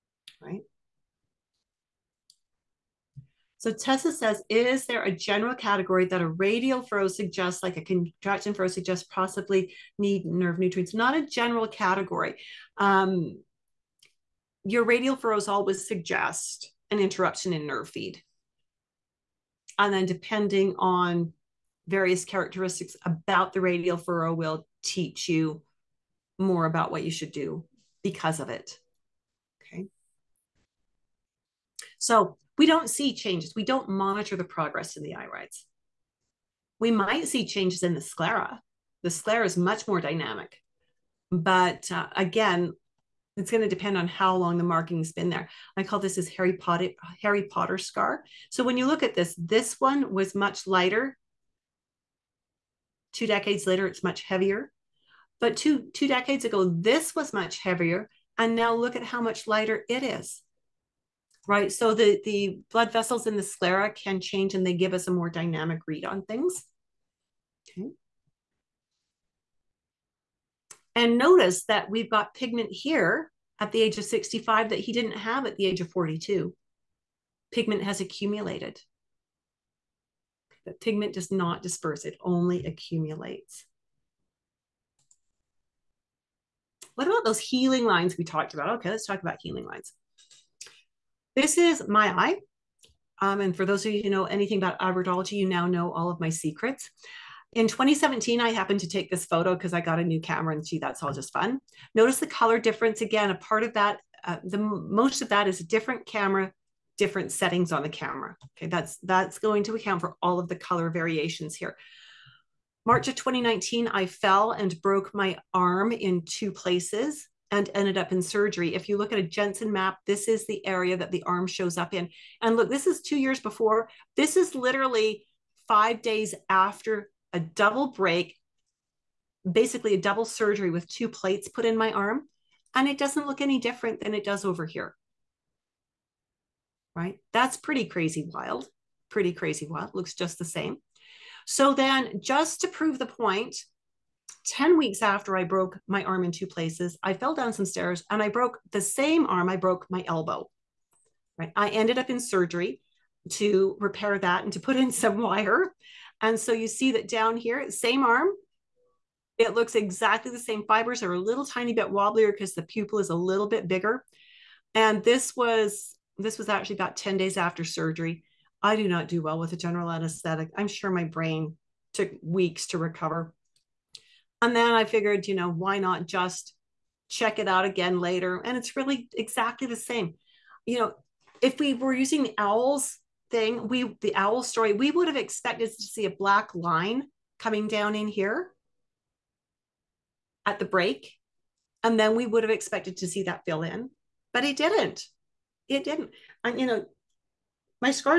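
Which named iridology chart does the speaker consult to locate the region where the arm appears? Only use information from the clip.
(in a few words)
Jensen map.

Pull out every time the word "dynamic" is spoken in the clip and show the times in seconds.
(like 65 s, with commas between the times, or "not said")
39 s, 65 s.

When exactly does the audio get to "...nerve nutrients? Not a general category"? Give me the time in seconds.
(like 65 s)
10 s.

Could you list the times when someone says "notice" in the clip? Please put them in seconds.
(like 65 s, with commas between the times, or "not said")
71 s, 101 s.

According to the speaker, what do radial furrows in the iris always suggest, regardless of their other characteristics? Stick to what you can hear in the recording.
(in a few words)
An interruption in nerve feed.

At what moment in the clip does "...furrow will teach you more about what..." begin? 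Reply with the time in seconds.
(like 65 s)
23 s.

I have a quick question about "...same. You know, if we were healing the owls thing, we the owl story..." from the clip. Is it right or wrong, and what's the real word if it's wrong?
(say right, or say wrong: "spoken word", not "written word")
wrong: "using", not "healing".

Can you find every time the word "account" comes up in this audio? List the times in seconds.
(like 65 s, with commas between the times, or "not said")
109 s.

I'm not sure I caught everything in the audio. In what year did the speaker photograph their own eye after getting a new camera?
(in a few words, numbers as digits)
2017.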